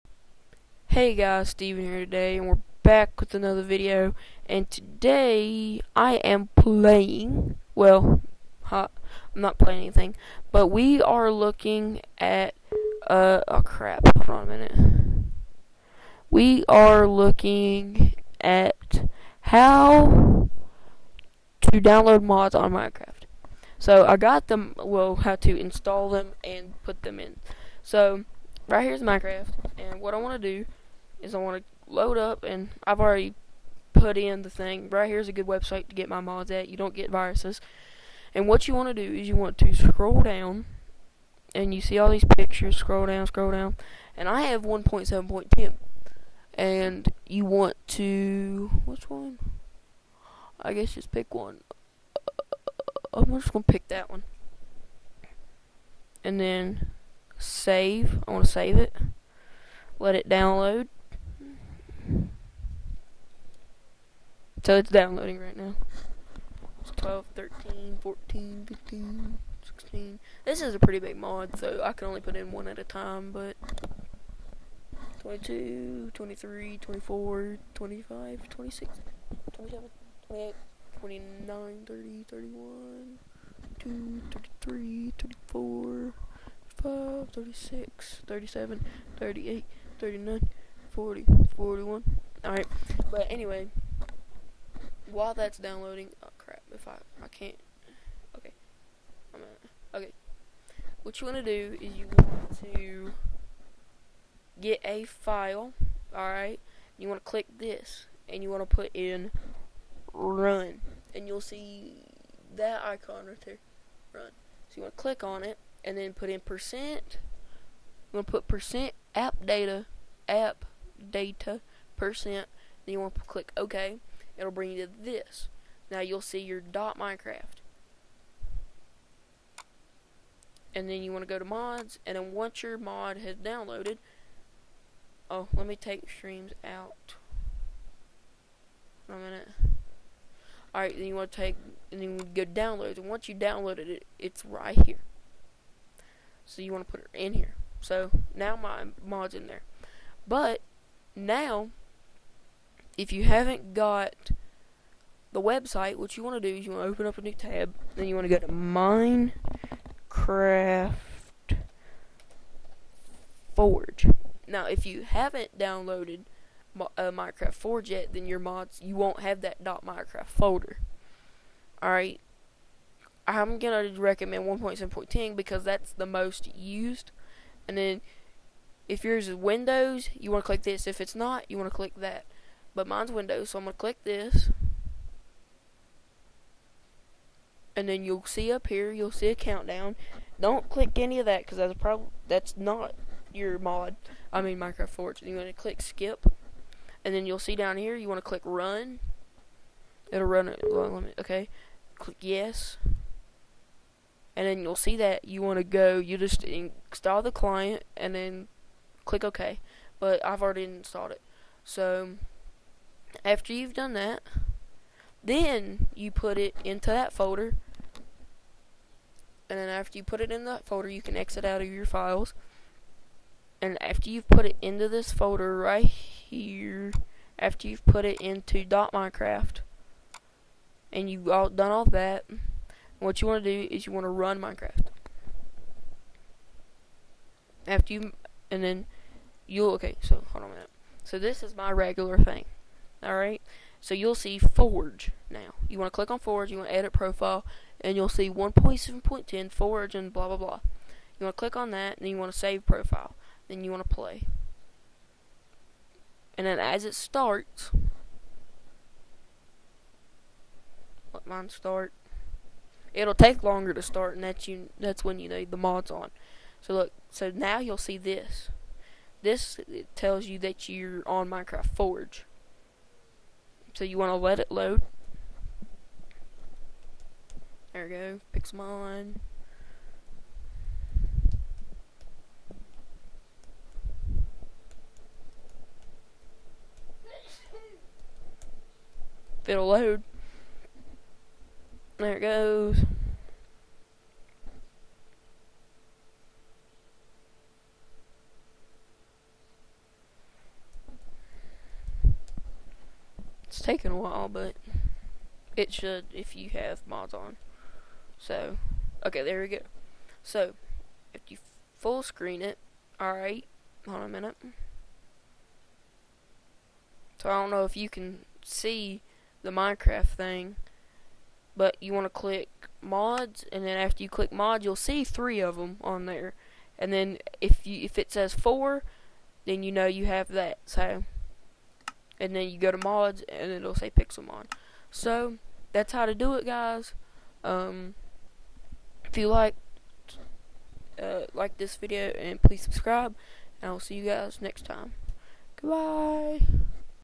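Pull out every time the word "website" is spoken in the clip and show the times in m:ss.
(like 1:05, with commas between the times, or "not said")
0:35, 2:35.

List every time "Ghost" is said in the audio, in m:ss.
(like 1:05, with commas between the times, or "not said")
not said.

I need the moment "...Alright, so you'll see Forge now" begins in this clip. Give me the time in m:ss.
4:03.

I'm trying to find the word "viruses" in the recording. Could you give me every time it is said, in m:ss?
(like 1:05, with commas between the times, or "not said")
0:37.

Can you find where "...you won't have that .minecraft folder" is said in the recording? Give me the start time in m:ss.
2:48.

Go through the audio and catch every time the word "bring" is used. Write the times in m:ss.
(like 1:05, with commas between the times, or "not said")
2:04.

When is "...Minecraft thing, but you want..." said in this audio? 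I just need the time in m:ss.
5:19.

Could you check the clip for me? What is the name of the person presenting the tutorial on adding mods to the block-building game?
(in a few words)
Steven.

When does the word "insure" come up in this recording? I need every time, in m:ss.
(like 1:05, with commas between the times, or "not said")
not said.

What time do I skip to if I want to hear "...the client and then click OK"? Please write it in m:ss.
3:27.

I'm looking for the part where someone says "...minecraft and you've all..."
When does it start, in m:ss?
3:48.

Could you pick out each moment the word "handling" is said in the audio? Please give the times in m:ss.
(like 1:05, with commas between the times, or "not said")
not said.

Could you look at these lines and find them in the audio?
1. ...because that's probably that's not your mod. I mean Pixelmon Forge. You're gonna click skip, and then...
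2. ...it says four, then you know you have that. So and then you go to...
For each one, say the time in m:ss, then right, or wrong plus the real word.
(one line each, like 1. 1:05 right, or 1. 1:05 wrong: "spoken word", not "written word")
1. 3:11 wrong: "Minecraft", not "Pixelmon"
2. 5:27 right.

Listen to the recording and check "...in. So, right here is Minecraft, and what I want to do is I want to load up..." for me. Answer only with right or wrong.
right.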